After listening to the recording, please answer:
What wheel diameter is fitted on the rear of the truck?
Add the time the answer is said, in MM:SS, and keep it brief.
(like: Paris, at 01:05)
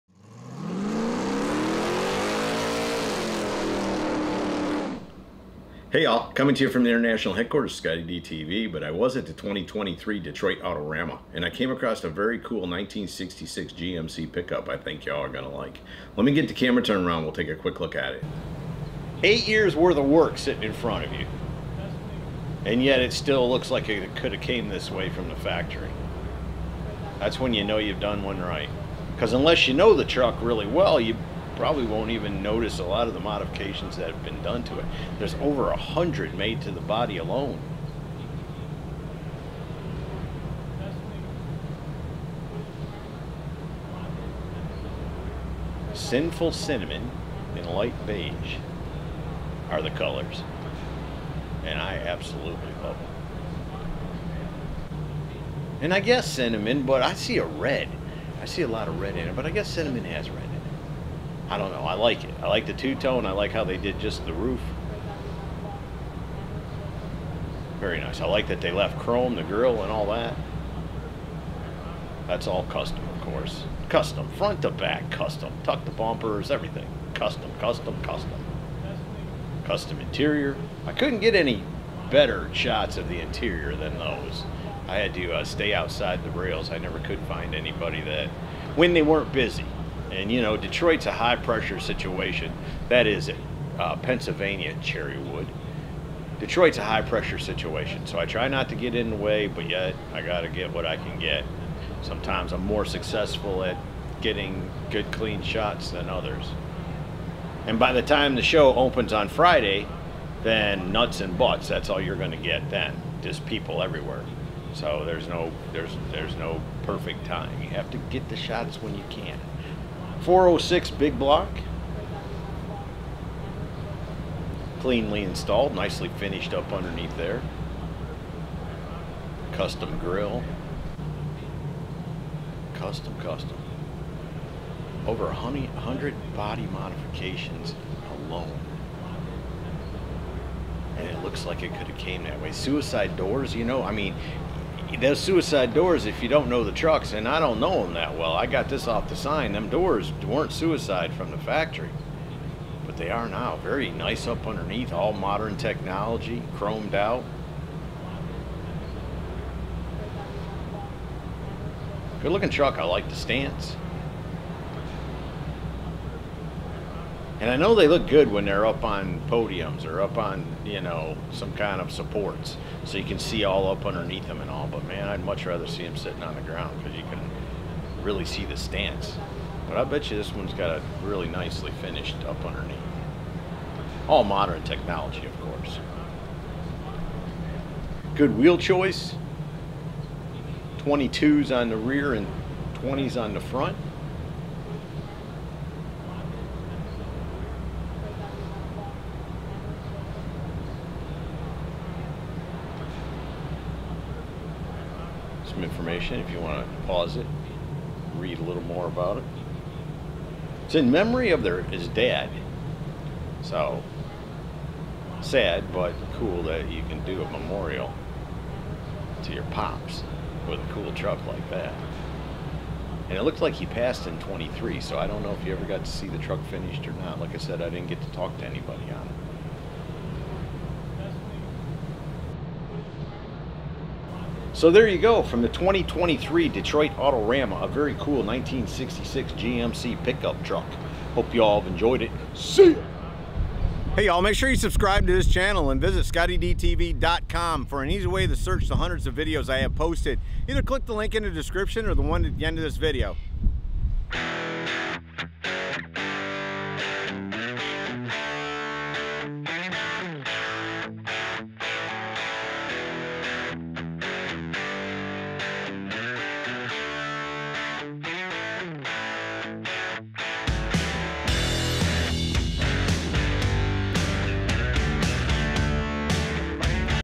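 22, at 03:10.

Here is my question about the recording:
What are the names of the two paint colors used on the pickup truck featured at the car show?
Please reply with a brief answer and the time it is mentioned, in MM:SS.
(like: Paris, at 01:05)
Sinful cinnamon and light beige, at 00:45.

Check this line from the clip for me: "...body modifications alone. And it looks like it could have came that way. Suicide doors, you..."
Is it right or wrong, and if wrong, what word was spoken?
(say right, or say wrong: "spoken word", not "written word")
right.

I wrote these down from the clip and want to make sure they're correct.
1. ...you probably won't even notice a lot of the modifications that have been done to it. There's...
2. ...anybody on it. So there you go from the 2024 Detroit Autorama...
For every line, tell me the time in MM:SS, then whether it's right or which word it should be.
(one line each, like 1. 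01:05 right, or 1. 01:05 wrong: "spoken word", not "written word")
1. 00:31 right
2. 03:48 wrong: "2023", not "2024".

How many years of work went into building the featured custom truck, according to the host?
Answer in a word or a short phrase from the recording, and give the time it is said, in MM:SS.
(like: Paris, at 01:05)
8, at 00:19.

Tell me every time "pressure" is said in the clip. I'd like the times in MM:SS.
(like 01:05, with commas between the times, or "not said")
01:31, 01:37.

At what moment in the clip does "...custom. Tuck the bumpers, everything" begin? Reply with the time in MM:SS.
01:15.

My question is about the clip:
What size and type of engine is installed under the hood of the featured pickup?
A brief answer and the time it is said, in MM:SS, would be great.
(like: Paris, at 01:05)
406 big block, at 02:00.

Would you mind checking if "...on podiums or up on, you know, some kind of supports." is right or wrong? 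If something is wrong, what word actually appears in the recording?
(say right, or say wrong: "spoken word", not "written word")
right.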